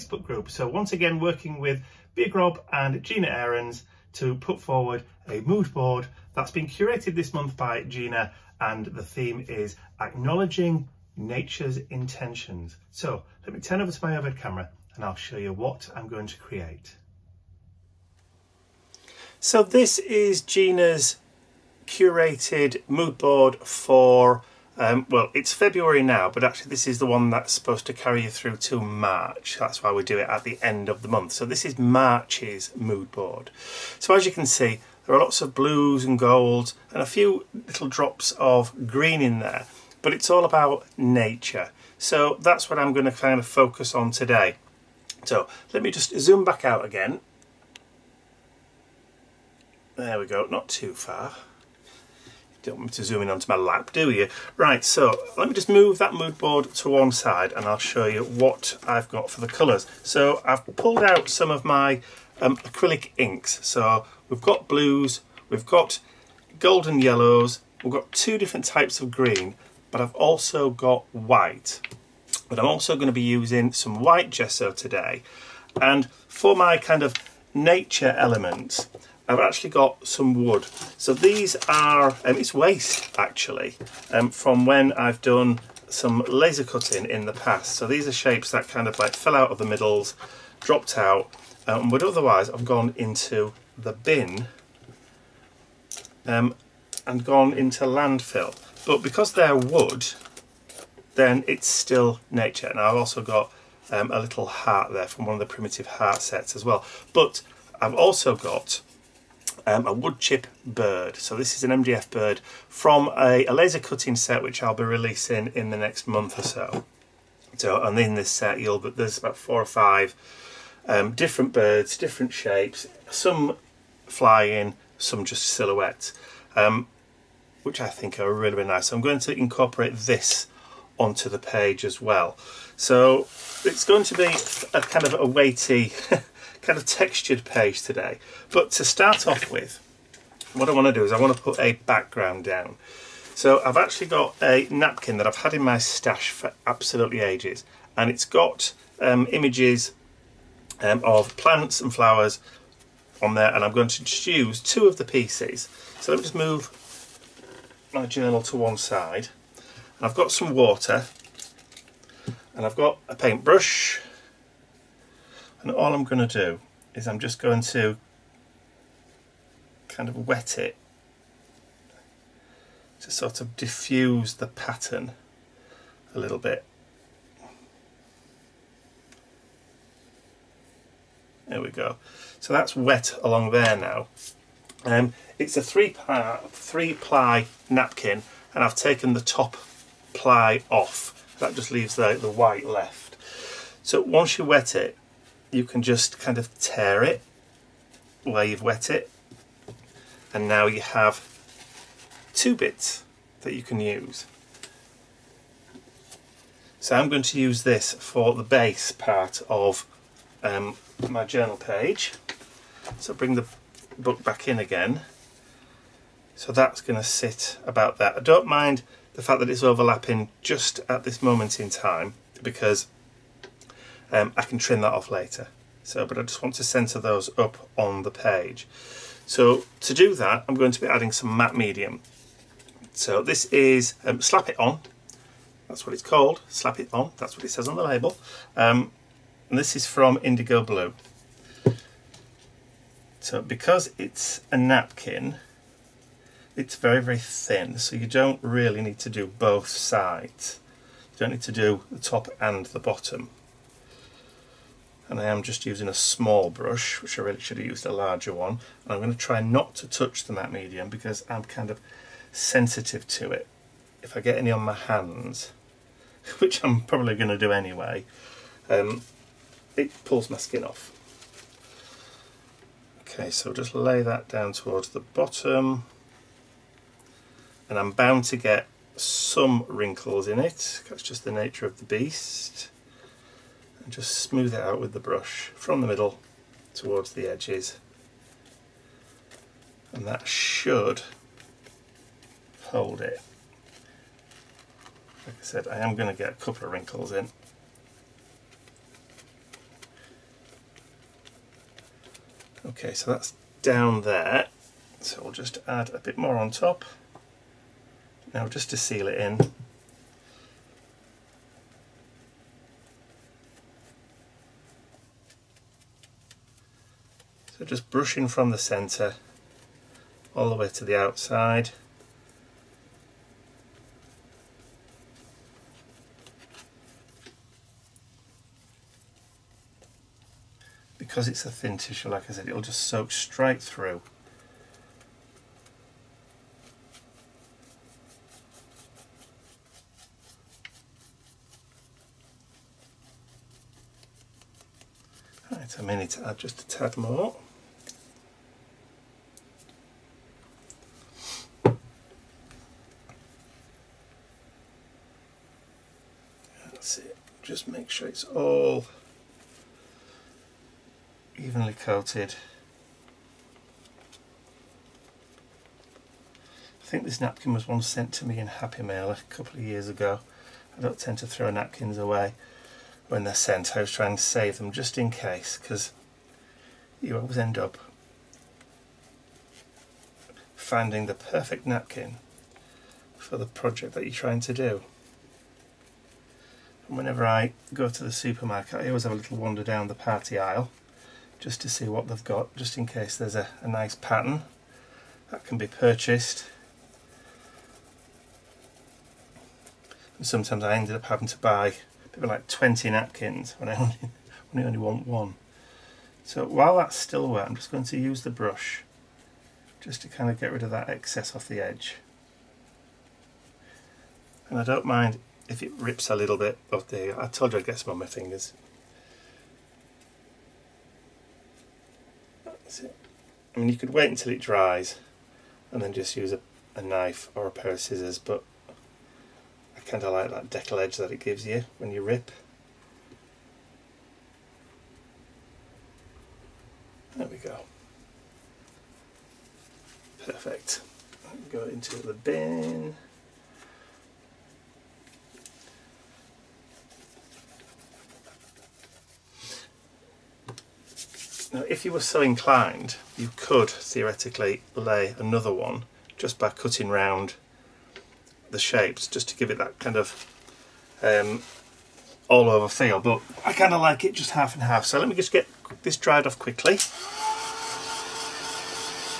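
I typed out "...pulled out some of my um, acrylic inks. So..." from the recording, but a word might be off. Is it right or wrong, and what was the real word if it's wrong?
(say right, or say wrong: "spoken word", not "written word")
right.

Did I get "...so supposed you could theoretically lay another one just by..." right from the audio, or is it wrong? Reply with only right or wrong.
wrong.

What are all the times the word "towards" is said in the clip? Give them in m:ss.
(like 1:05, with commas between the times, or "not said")
4:34, 4:46.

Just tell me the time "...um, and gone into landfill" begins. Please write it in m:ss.
1:36.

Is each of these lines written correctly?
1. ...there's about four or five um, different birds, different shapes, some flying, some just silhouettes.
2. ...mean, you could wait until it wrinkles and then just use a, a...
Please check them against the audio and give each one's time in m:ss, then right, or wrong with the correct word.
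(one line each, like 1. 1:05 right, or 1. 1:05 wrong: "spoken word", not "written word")
1. 1:58 right
2. 7:03 wrong: "dries", not "wrinkles".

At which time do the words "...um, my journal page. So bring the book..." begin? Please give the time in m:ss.
3:30.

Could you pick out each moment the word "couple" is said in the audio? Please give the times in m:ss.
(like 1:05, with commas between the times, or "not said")
4:56, 6:09.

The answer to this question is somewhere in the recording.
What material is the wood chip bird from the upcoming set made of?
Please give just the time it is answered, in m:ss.
1:51.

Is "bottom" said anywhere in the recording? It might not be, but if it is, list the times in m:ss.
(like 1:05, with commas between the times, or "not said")
4:12, 4:34.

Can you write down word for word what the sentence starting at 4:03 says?
So because it's a napkin, it's very, very thin.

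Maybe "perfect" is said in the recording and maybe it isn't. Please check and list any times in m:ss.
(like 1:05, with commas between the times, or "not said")
6:21, 7:20.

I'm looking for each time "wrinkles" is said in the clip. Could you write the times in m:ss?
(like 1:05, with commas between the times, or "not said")
4:39, 4:56.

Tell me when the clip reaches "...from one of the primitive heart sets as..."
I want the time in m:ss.
1:45.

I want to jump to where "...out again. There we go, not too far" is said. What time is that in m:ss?
0:46.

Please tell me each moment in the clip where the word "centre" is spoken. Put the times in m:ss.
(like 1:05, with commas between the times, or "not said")
3:46, 5:18.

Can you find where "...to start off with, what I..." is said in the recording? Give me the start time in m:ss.
2:18.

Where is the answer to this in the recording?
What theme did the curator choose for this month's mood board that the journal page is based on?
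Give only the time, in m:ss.
0:10.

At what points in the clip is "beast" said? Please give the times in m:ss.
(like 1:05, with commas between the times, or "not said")
4:41.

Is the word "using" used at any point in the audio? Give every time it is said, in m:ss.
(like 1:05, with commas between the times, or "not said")
1:13, 4:15.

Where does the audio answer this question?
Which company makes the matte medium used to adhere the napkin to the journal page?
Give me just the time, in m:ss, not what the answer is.
4:00.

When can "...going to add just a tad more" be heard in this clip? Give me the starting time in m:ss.
5:45.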